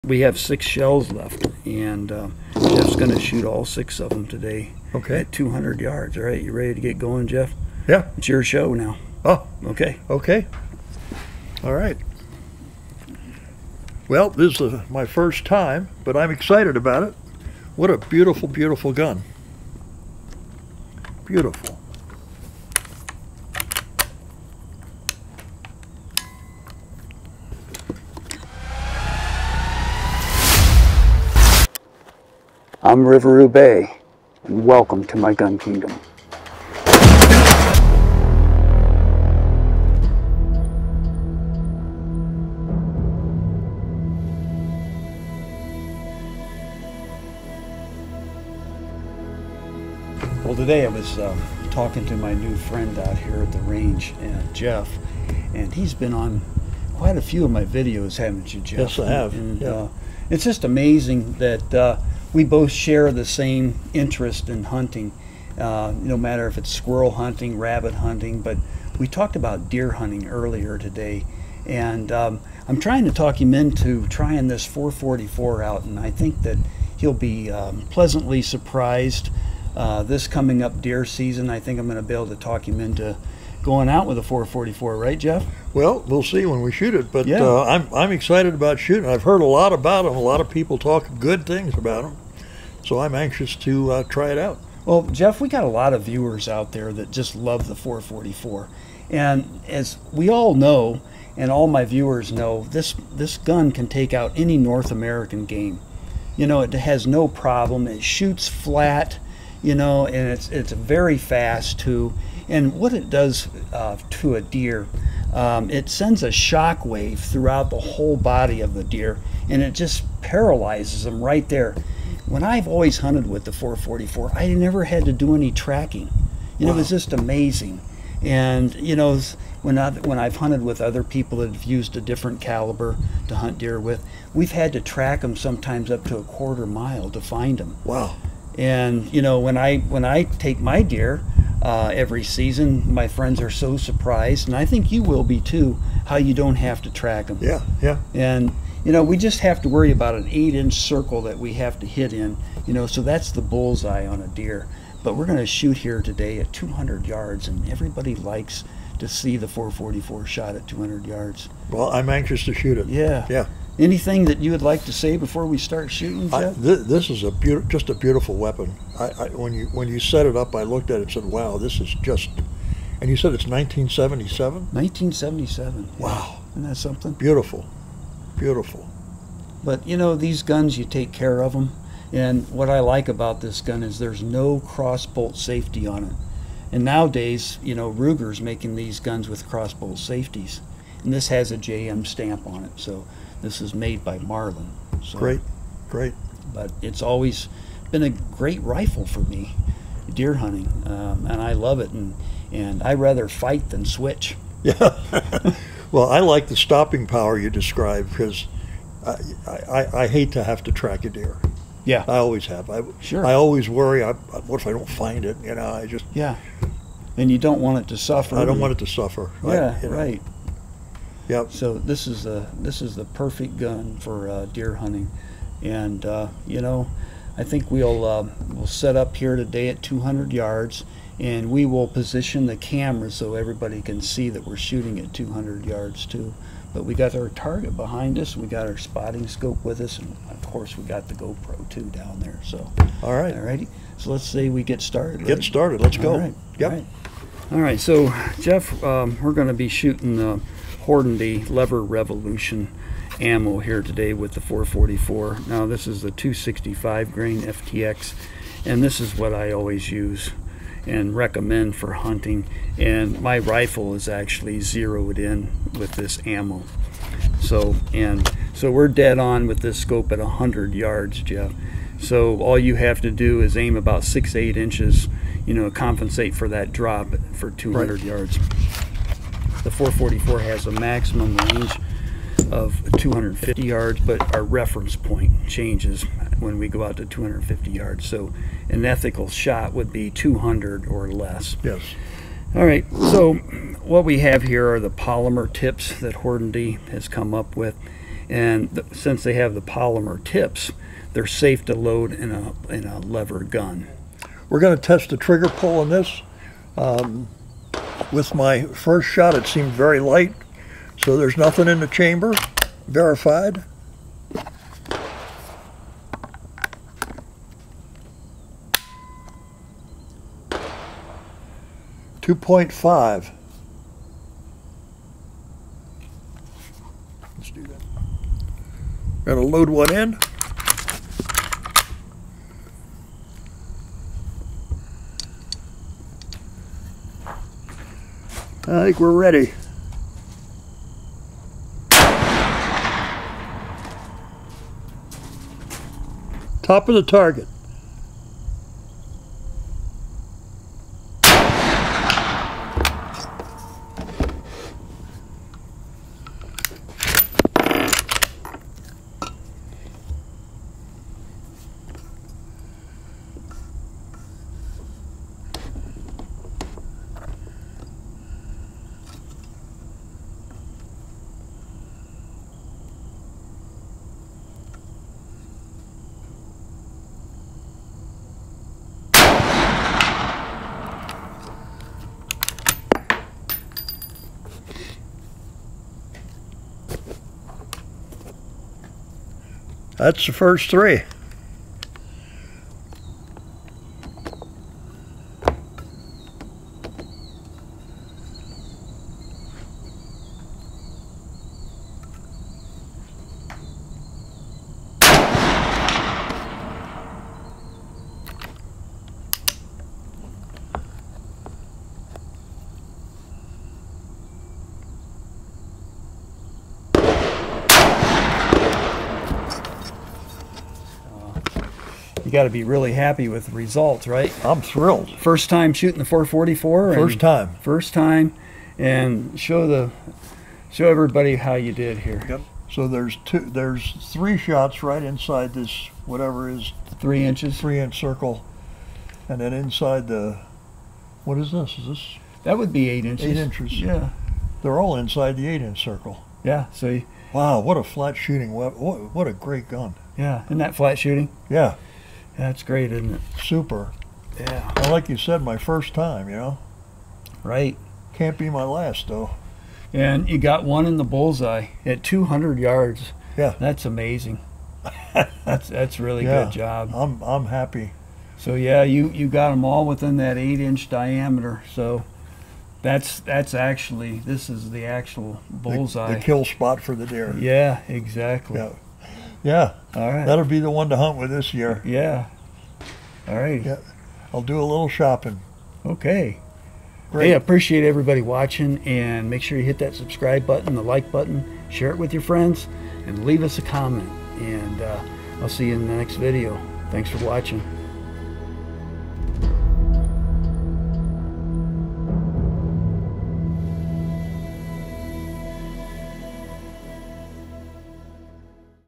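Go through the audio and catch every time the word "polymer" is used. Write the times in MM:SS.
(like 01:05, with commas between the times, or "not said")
04:54, 04:59.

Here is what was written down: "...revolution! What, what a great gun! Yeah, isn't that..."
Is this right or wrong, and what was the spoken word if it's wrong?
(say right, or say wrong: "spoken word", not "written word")
wrong: "weapon", not "revolution".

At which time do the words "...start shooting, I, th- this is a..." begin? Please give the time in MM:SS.
02:45.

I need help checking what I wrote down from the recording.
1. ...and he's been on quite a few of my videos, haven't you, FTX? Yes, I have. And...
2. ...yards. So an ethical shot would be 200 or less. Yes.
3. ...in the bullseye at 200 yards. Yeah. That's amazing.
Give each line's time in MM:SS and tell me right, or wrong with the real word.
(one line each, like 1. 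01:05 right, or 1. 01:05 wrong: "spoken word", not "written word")
1. 00:55 wrong: "Jeff", not "FTX"
2. 04:47 right
3. 07:40 right.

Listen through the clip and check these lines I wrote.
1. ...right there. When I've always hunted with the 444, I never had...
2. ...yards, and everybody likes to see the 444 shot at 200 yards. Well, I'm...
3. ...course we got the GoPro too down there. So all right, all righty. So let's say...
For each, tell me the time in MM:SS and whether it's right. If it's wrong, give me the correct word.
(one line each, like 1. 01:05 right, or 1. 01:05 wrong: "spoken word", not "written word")
1. 02:01 right
2. 02:37 right
3. 04:00 right.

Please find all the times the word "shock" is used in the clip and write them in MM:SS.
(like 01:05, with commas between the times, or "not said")
01:56.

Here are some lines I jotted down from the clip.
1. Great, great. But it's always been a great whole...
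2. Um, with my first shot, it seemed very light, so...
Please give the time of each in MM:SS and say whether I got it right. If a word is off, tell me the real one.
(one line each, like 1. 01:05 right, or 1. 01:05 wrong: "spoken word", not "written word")
1. 03:15 wrong: "rifle", not "whole"
2. 05:06 right.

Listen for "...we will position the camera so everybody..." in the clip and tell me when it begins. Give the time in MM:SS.
03:51.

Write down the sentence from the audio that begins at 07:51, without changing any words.
So that's that's actually this is the actual bullseye.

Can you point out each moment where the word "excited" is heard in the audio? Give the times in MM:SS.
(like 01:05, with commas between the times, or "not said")
00:16, 01:28.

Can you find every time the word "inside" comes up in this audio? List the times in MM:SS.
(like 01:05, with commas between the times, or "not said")
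07:15, 07:19, 07:24.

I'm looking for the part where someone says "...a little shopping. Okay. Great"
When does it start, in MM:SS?
08:04.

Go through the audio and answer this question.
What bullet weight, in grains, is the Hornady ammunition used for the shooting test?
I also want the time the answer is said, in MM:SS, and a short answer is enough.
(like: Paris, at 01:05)
265 grain, at 04:16.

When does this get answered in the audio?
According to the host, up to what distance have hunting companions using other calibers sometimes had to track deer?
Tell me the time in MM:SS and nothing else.
02:16.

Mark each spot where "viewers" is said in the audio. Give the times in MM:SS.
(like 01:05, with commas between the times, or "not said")
01:36, 01:41.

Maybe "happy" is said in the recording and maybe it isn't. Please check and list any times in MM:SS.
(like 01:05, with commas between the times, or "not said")
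07:02, 07:47.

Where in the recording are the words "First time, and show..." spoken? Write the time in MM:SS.
07:07.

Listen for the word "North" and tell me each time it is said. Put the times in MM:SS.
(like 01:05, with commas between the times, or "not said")
01:44.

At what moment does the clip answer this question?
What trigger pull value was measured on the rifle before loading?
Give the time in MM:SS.
05:22.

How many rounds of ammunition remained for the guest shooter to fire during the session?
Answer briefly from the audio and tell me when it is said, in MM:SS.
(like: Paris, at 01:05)
6, at 00:00.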